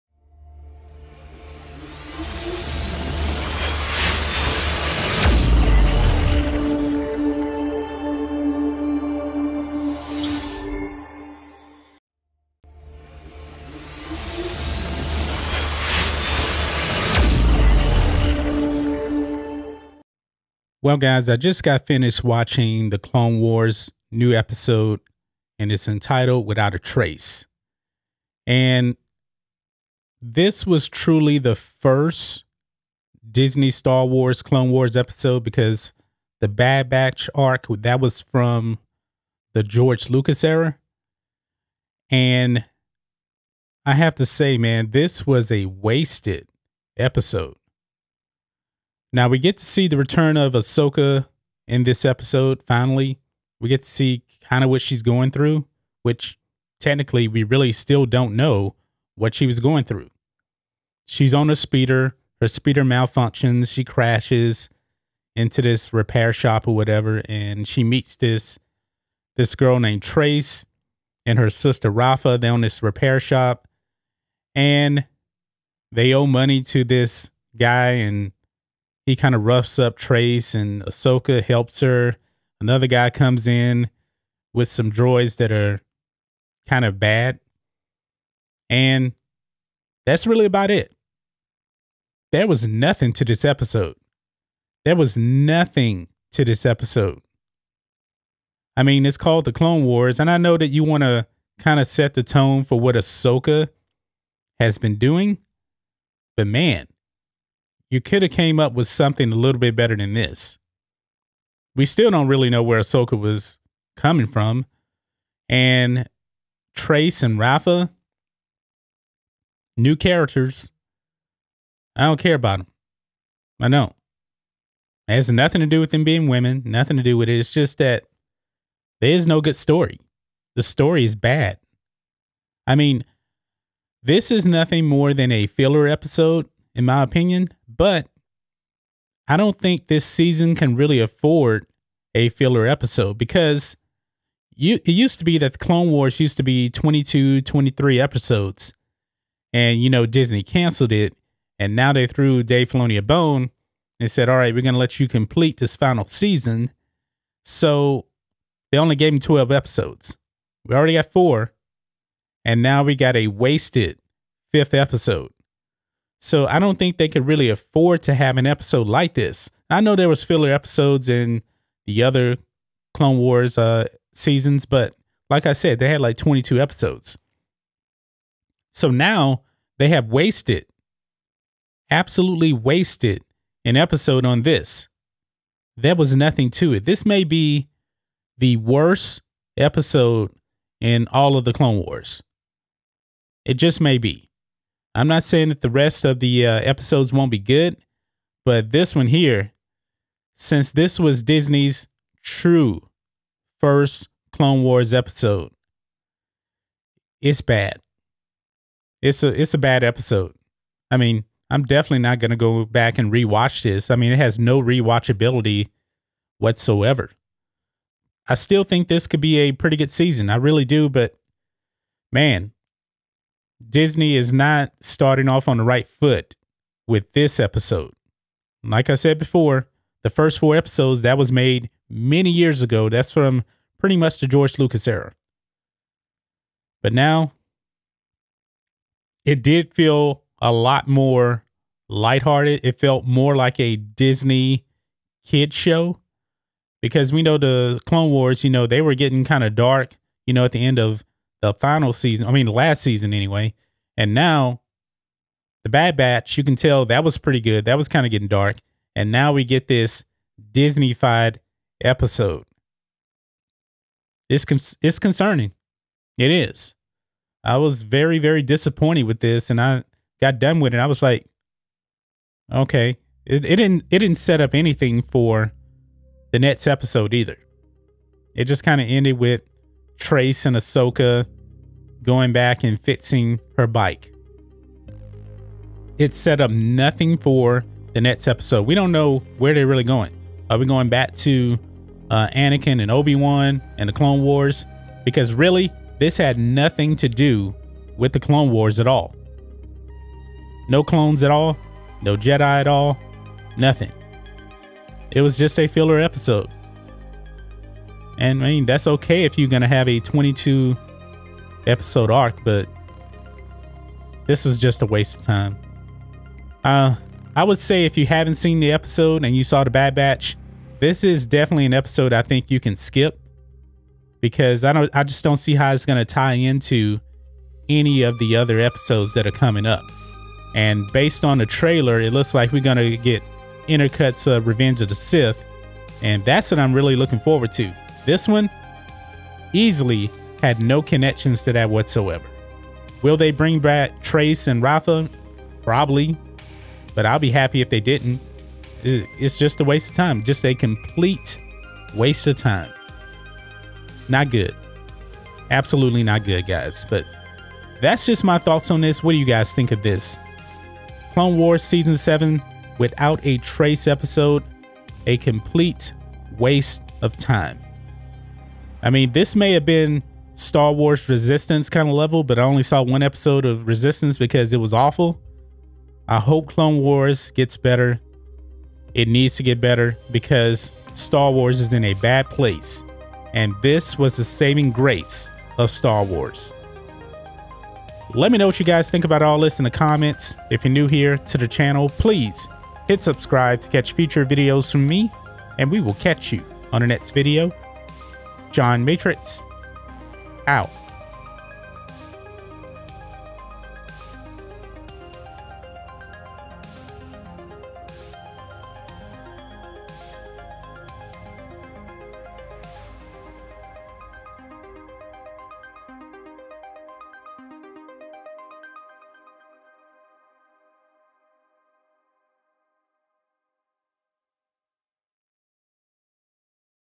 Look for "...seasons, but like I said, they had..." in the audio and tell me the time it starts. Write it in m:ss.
2:54.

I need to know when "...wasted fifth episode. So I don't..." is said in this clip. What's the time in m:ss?
2:43.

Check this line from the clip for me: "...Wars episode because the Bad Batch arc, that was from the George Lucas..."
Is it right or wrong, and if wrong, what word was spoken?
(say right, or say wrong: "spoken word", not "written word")
right.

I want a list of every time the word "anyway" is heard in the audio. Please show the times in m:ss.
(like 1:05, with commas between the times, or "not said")
4:13.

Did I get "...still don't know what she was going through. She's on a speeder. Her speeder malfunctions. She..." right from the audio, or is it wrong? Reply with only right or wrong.
right.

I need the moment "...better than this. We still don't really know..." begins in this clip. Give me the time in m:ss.
1:49.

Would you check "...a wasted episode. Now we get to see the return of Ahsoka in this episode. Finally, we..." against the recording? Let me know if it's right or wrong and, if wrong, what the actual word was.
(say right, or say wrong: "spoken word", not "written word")
right.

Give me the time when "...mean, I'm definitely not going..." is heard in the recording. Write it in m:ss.
3:30.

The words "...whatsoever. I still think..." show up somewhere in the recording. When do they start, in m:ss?
3:36.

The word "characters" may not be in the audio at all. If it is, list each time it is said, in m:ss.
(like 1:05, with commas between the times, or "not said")
1:59.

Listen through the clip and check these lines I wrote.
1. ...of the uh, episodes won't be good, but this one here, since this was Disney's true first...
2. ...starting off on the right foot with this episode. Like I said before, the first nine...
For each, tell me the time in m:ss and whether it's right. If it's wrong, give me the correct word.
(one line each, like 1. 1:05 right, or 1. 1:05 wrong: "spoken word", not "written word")
1. 3:16 right
2. 3:44 wrong: "four", not "nine".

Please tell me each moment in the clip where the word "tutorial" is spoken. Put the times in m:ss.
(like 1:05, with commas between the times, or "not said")
not said.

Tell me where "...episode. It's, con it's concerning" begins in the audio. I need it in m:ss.
4:21.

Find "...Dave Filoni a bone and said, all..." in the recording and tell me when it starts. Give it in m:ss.
2:32.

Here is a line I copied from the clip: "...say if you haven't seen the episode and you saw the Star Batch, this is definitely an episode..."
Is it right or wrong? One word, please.
wrong.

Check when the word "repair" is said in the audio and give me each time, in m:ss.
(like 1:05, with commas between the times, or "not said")
1:05, 1:12.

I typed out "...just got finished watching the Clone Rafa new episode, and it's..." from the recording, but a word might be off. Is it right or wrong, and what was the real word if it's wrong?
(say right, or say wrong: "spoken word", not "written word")
wrong: "Wars", not "Rafa".